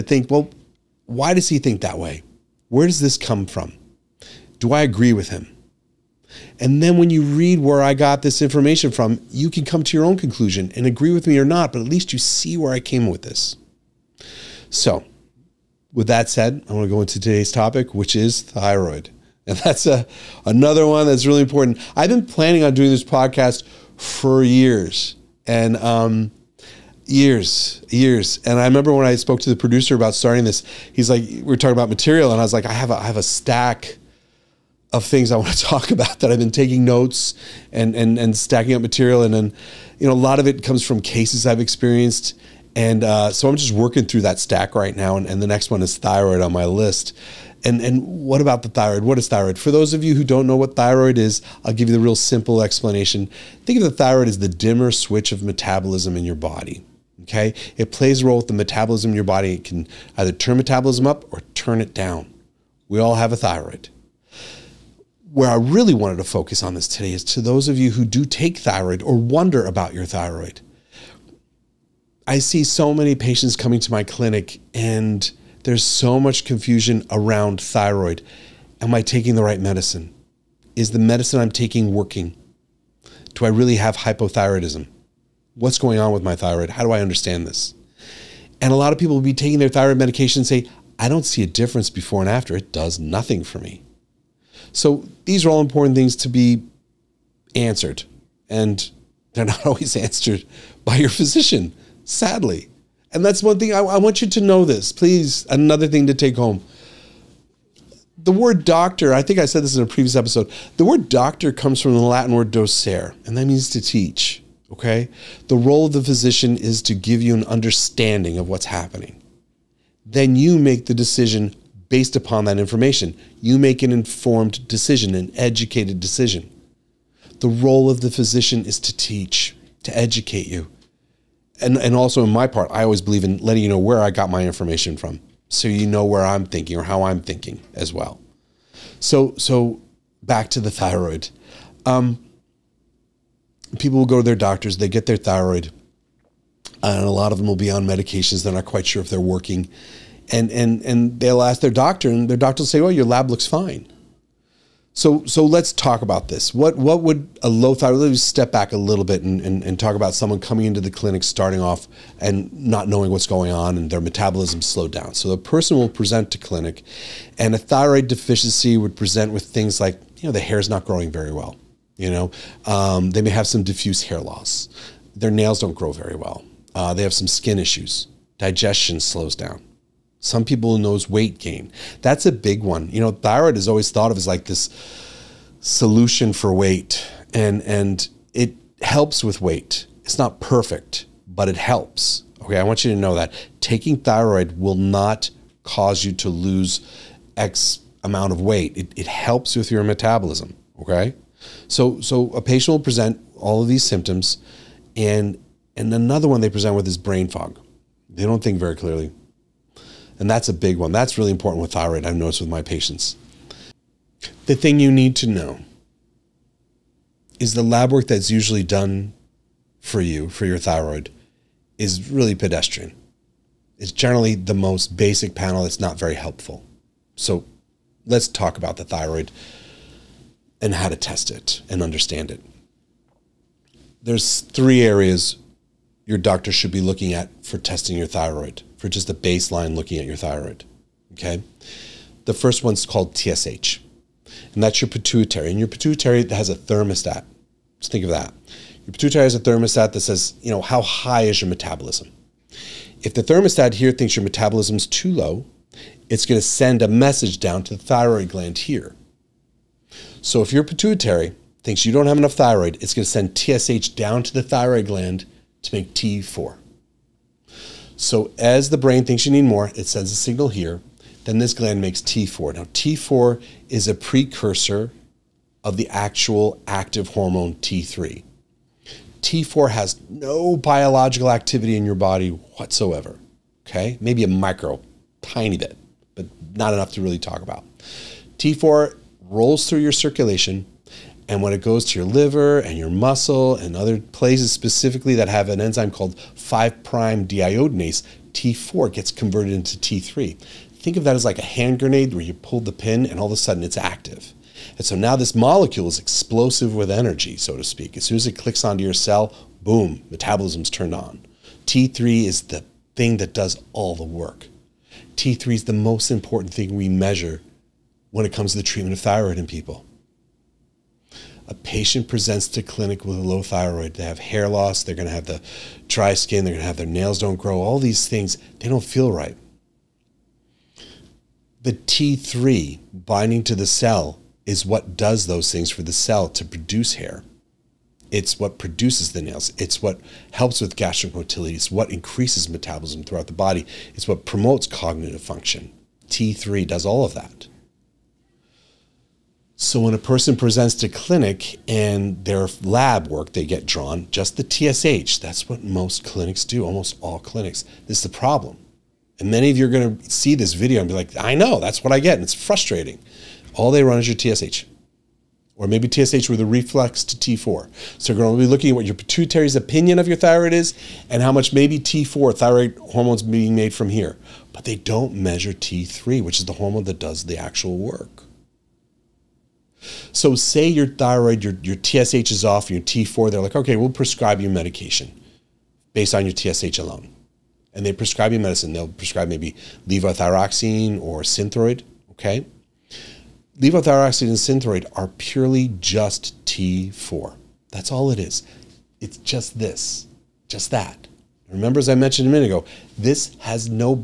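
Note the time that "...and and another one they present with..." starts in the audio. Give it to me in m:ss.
3:24.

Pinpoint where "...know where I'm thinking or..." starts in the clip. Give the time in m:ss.
2:15.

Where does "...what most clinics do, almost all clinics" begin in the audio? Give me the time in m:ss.
5:55.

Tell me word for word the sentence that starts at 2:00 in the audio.
Then you make the decision based upon that information.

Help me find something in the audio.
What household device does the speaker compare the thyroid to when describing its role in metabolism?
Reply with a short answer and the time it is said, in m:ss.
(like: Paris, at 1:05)
dimmer switch, at 0:54.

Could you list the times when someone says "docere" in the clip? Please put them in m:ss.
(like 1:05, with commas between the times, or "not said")
1:52.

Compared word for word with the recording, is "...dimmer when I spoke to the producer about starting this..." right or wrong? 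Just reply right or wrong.
wrong.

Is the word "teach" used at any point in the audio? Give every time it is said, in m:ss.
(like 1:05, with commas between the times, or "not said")
1:53, 2:08.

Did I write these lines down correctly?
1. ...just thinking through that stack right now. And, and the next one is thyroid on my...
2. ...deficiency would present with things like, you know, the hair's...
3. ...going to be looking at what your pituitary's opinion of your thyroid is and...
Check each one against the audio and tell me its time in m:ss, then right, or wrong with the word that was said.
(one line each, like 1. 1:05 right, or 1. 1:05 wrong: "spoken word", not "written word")
1. 0:43 wrong: "working", not "thinking"
2. 2:48 right
3. 6:08 right.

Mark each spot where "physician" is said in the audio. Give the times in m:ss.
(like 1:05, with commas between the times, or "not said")
1:41, 1:56, 2:08.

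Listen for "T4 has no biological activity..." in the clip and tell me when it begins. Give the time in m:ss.
4:39.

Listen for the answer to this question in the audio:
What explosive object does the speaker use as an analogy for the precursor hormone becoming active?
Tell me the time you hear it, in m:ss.
5:01.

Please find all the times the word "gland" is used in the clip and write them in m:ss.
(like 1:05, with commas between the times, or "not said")
4:18, 4:24, 4:31.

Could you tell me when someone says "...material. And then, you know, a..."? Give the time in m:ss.
0:38.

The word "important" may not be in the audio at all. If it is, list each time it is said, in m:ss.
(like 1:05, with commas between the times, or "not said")
0:21, 1:35, 3:31, 5:16.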